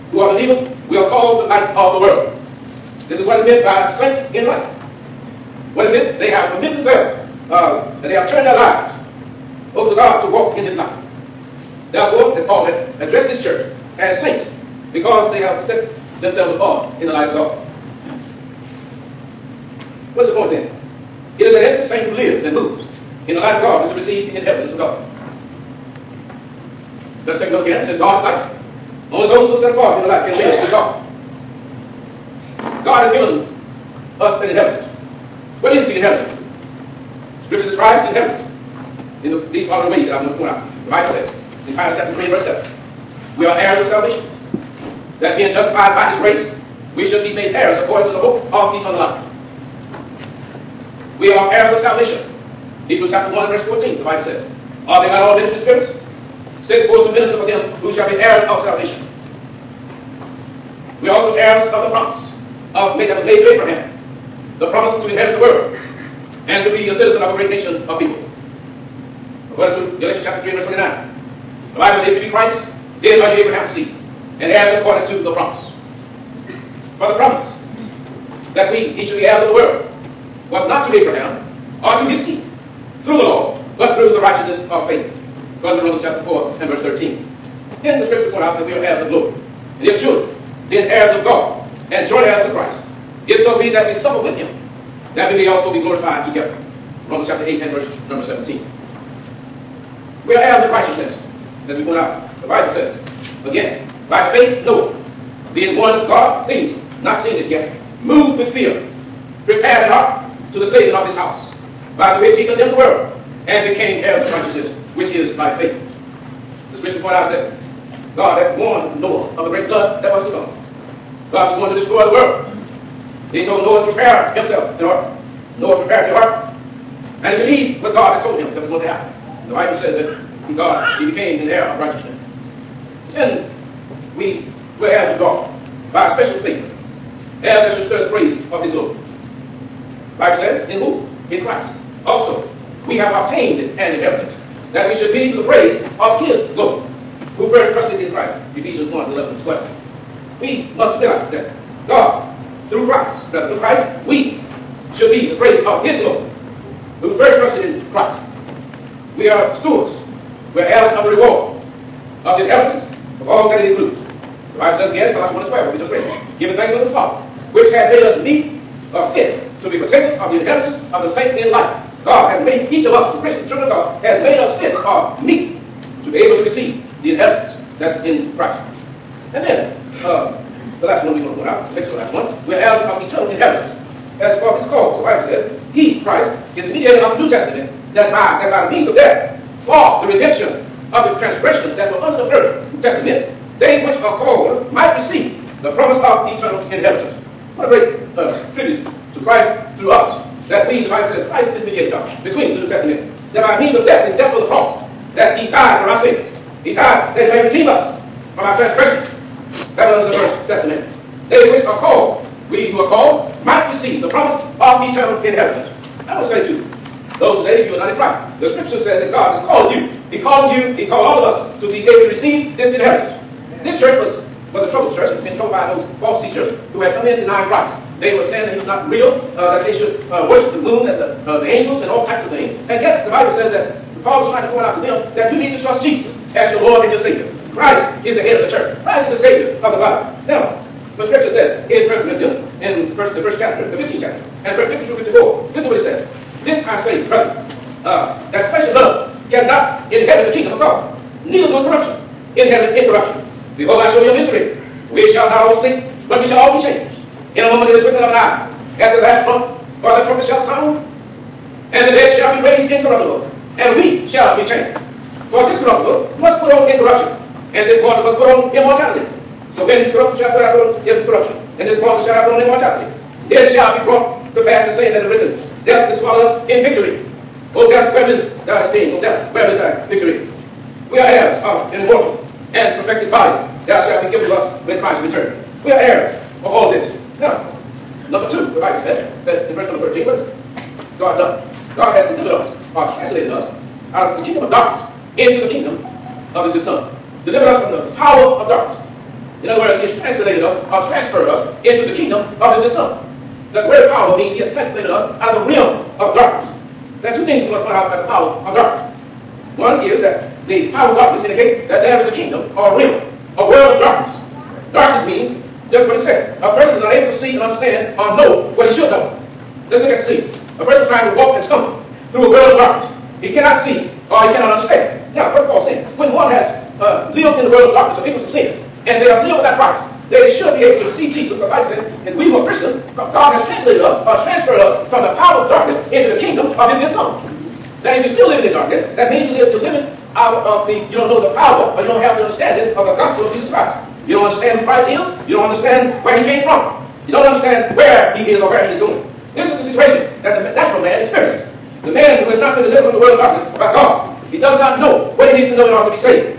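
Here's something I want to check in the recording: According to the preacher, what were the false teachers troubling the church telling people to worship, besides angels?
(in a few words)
the moon.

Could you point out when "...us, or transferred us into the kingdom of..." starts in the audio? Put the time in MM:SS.
05:00.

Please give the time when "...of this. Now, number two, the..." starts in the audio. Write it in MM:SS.
04:46.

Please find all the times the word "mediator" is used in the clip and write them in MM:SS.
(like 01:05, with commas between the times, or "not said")
03:06, 03:21.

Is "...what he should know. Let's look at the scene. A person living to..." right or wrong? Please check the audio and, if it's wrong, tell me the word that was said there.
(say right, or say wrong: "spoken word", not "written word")
wrong: "trying", not "living".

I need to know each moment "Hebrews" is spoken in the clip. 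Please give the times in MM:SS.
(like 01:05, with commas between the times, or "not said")
00:52.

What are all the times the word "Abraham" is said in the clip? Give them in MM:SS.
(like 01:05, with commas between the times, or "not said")
01:03, 01:13, 01:20.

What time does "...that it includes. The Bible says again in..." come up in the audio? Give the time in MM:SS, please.
02:43.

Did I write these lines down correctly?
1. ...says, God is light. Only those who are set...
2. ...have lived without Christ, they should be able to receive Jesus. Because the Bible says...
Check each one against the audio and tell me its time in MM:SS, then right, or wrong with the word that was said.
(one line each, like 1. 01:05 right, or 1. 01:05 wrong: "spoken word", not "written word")
1. 00:27 right
2. 05:29 right.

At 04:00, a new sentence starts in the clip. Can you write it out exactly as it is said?
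Now, the scripture says, in First Corinthians, in first, the first chapter, the 15th chapter, and verse 50 through 54.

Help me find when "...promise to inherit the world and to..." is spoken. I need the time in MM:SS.
01:04.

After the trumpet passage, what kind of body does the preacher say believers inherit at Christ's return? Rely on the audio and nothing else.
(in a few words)
an immortal and perfected body.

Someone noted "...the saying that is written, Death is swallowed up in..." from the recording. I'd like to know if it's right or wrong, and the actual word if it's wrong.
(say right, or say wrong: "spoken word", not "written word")
right.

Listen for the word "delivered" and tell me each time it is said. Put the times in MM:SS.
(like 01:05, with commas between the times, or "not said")
04:52, 04:57, 05:52.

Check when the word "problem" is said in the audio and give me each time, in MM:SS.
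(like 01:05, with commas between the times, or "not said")
not said.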